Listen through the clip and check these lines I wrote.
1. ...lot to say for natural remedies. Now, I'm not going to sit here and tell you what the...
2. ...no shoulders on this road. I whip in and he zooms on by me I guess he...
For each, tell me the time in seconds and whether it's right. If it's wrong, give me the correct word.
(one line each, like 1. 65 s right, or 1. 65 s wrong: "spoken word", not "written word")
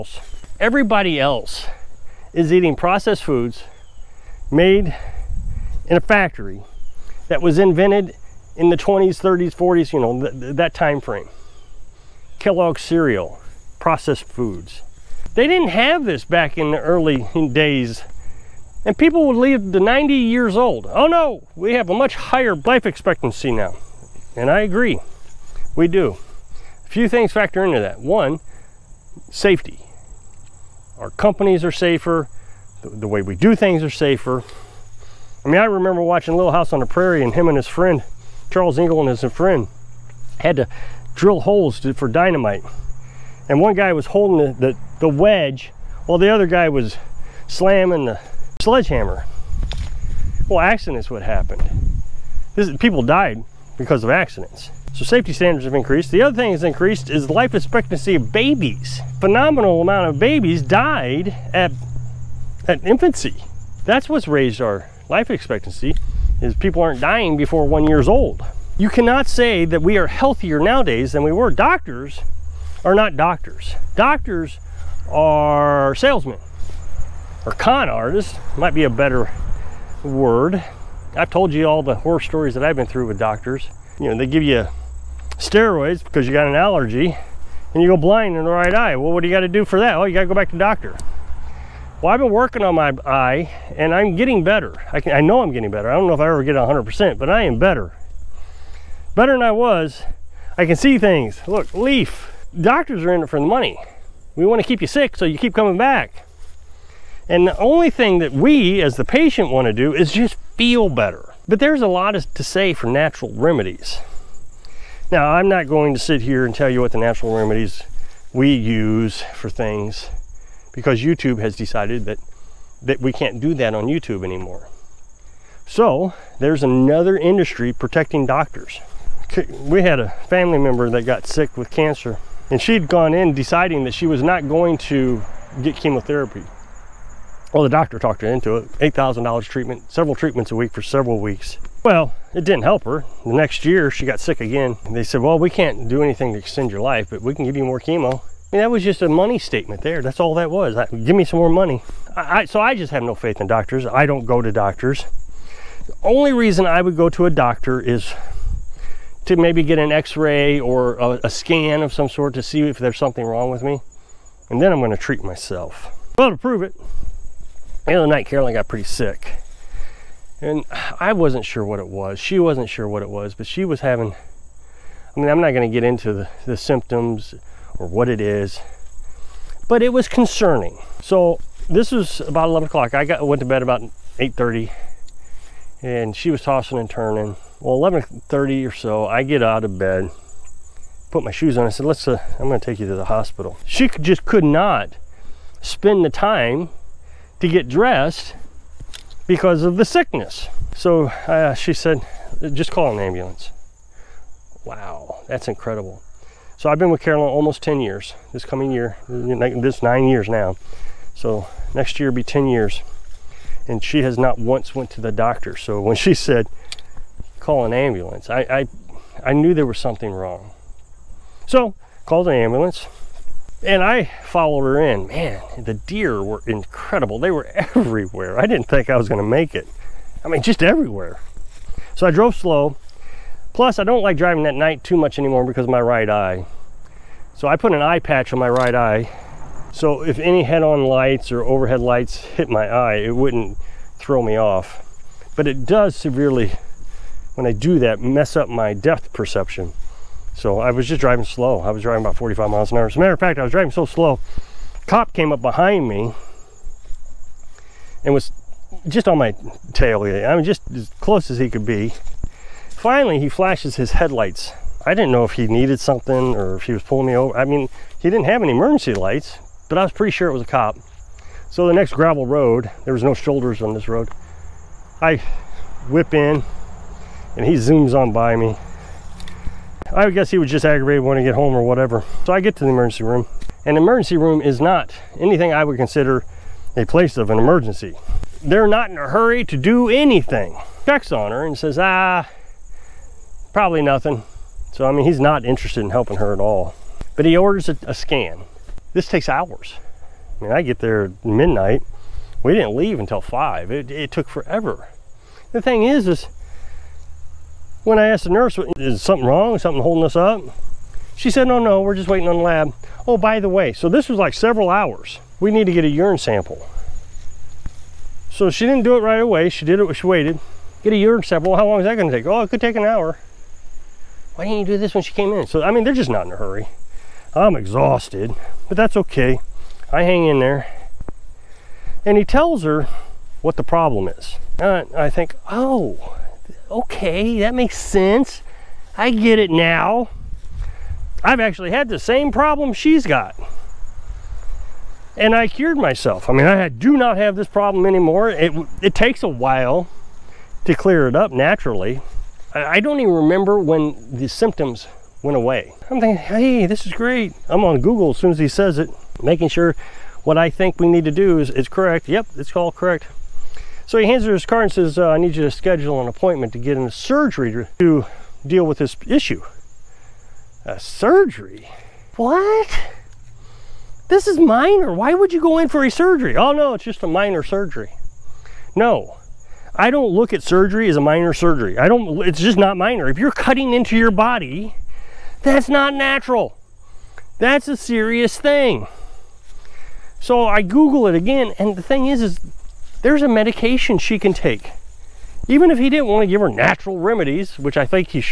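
1. 111 s right
2. 273 s right.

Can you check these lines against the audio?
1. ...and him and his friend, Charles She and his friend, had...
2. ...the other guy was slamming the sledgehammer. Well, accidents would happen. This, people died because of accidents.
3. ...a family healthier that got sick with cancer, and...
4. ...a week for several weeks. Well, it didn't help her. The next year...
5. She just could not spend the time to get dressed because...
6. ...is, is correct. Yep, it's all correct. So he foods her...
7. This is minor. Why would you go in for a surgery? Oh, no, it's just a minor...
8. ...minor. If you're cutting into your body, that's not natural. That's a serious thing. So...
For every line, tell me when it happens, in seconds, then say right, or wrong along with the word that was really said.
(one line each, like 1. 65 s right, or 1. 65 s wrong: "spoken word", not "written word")
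1. 37 s wrong: "Ingalls", not "She"
2. 46 s right
3. 129 s wrong: "member", not "healthier"
4. 140 s right
5. 193 s right
6. 361 s wrong: "hands", not "foods"
7. 374 s right
8. 382 s right.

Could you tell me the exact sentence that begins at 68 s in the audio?
You cannot say that we are healthier nowadays than we were.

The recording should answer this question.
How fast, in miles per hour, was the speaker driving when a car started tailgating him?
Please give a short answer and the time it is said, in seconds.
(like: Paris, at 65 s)
45, at 252 s.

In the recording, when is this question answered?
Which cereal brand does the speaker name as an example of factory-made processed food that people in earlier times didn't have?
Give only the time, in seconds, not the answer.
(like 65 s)
12 s.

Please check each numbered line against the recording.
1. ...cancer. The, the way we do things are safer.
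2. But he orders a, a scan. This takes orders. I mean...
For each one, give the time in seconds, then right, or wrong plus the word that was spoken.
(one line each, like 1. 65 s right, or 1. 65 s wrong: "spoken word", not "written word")
1. 31 s wrong: "safer", not "cancer"
2. 297 s wrong: "hours", not "orders".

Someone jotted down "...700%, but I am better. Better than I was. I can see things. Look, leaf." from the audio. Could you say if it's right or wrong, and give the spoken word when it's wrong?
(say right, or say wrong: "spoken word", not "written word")
wrong: "100", not "700".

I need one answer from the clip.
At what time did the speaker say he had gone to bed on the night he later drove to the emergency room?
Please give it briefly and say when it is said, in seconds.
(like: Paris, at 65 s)
8:30, at 184 s.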